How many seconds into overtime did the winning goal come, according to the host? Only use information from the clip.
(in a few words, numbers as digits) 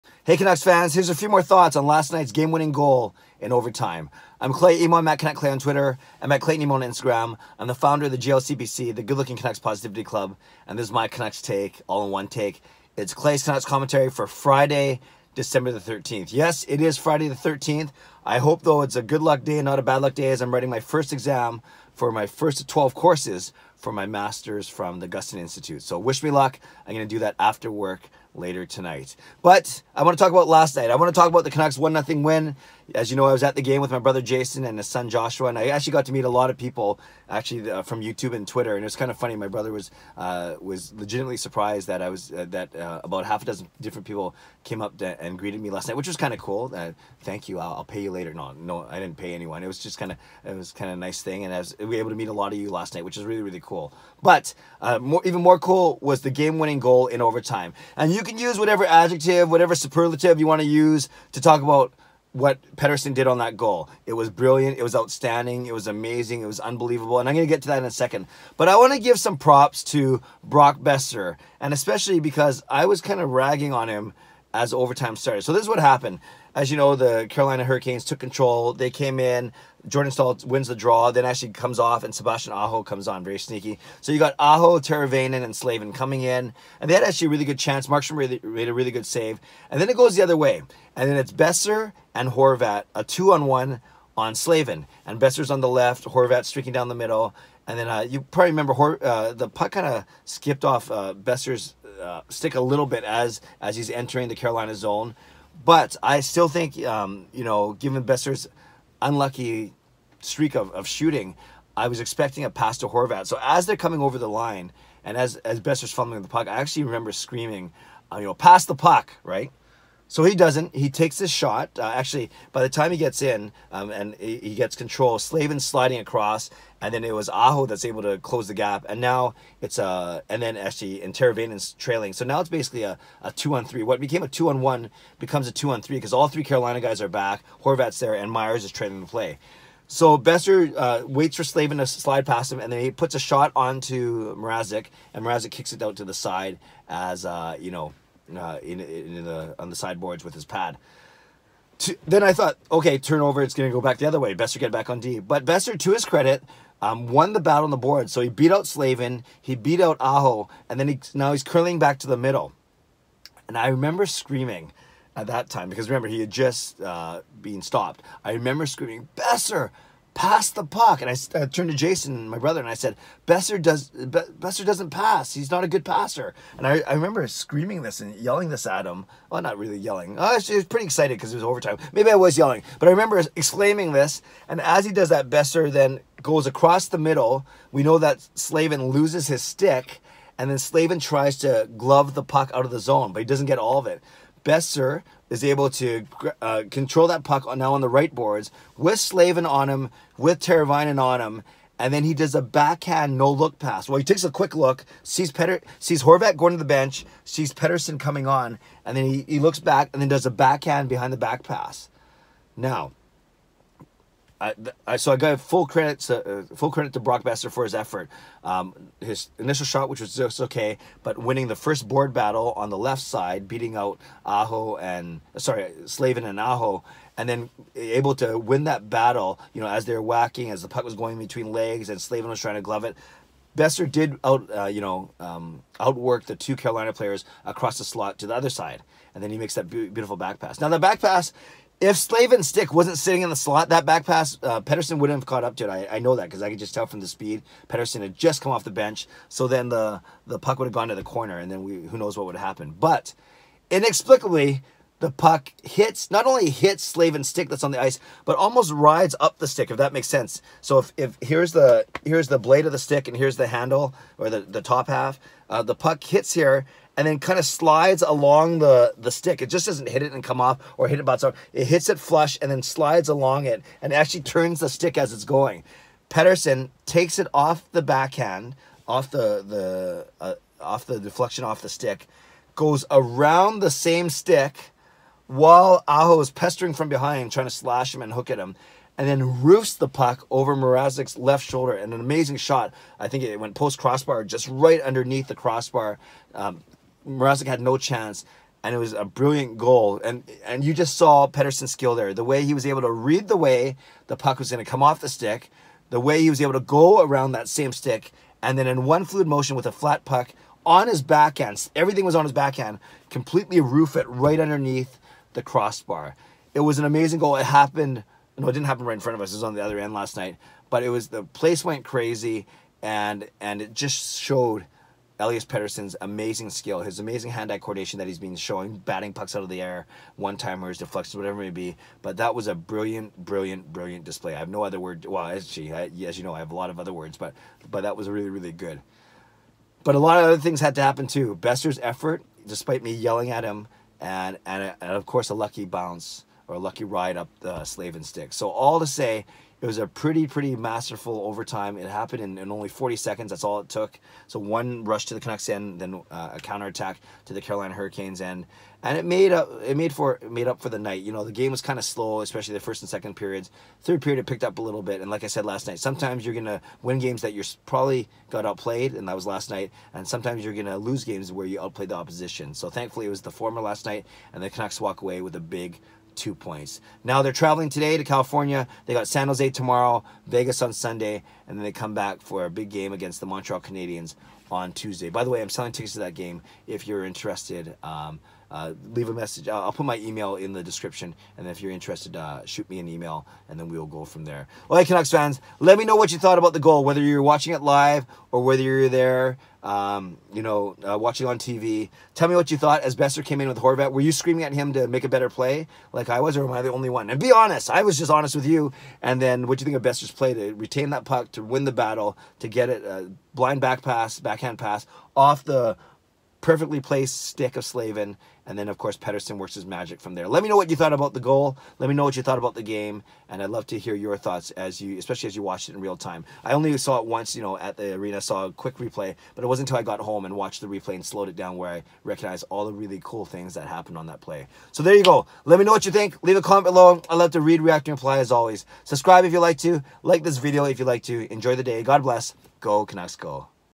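40.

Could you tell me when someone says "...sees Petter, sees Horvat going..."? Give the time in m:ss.
3:25.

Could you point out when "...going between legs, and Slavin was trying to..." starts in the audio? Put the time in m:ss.
3:50.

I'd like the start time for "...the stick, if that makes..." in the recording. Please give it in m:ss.
4:19.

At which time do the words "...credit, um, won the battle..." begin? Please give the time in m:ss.
2:36.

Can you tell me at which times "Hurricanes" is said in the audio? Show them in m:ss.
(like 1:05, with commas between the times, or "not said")
1:17, 5:57.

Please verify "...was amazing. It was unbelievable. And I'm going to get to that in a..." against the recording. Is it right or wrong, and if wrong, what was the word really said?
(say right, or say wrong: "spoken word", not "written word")
right.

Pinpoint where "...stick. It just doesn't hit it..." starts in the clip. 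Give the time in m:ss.
4:29.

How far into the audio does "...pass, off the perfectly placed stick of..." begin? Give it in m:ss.
6:54.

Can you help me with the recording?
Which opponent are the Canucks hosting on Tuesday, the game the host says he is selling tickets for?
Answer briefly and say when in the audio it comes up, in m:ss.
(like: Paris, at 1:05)
Montreal Canadiens, at 6:23.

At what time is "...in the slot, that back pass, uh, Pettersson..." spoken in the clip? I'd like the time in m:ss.
4:03.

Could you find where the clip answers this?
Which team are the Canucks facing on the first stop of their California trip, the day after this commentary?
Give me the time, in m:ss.
6:19.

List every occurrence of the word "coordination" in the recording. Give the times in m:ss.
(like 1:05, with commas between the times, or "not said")
5:27.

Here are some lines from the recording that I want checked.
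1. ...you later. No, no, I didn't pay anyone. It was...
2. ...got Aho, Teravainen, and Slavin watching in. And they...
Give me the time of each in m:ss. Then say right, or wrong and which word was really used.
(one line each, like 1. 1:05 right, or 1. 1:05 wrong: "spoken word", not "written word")
1. 0:48 right
2. 1:24 wrong: "coming", not "watching".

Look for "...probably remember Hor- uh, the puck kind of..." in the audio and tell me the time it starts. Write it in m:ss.
1:38.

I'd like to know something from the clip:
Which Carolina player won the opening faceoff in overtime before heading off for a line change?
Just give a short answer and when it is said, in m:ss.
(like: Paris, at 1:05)
Jordan Staal, at 1:19.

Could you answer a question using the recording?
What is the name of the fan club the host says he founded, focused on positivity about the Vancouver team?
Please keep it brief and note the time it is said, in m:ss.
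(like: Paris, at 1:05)
GLCBC, at 0:08.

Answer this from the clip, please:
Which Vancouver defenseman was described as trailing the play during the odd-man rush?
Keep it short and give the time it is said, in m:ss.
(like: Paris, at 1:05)
Myers, at 2:18.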